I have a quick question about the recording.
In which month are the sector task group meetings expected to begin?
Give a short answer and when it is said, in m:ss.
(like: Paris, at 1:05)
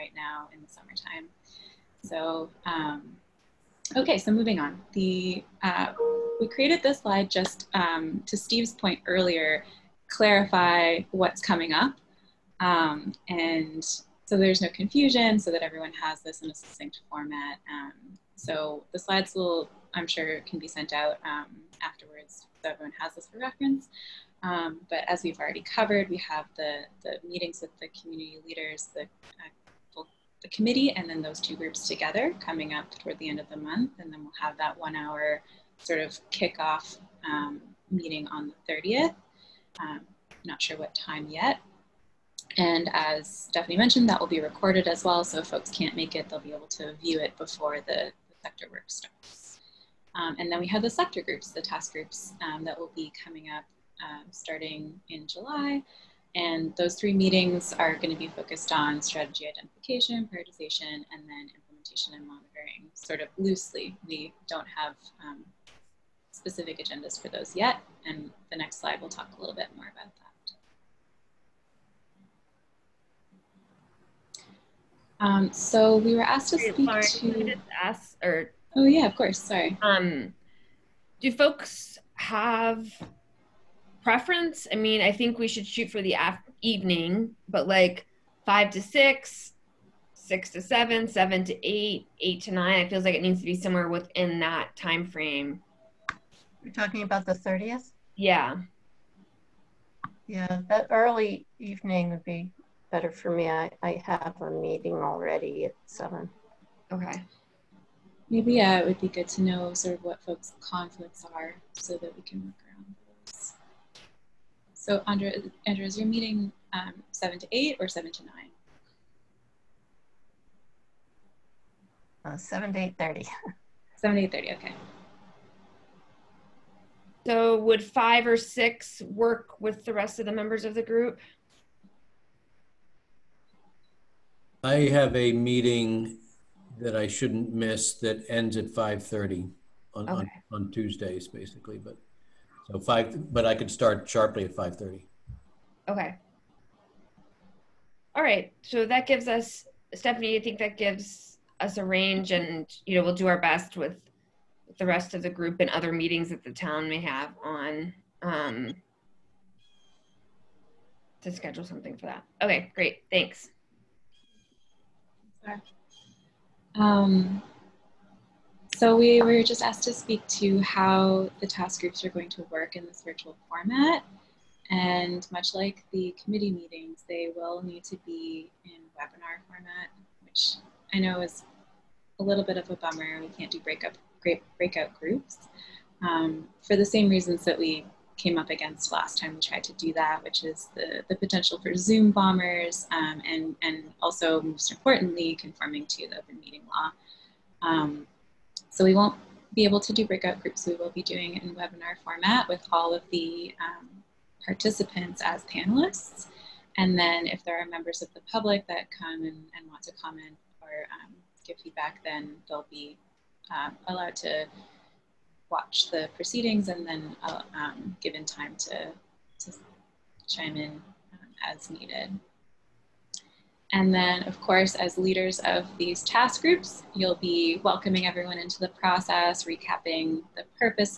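July, at 0:55.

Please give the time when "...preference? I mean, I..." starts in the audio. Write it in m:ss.
1:24.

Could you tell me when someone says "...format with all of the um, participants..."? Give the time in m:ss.
3:22.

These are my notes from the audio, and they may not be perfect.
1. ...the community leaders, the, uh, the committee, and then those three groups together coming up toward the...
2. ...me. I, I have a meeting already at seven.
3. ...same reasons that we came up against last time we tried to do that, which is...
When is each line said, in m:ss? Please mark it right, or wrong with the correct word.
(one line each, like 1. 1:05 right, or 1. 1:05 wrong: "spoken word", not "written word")
1. 0:27 wrong: "two", not "three"
2. 1:43 right
3. 3:06 right.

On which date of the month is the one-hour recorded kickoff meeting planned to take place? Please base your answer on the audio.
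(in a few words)
30th.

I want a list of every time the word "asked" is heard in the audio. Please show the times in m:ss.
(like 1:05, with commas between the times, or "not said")
1:16, 2:49.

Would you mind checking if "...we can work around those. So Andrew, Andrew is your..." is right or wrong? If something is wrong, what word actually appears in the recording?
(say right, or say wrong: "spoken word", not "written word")
right.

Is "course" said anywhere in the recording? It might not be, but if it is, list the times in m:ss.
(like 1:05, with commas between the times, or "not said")
1:19, 3:44.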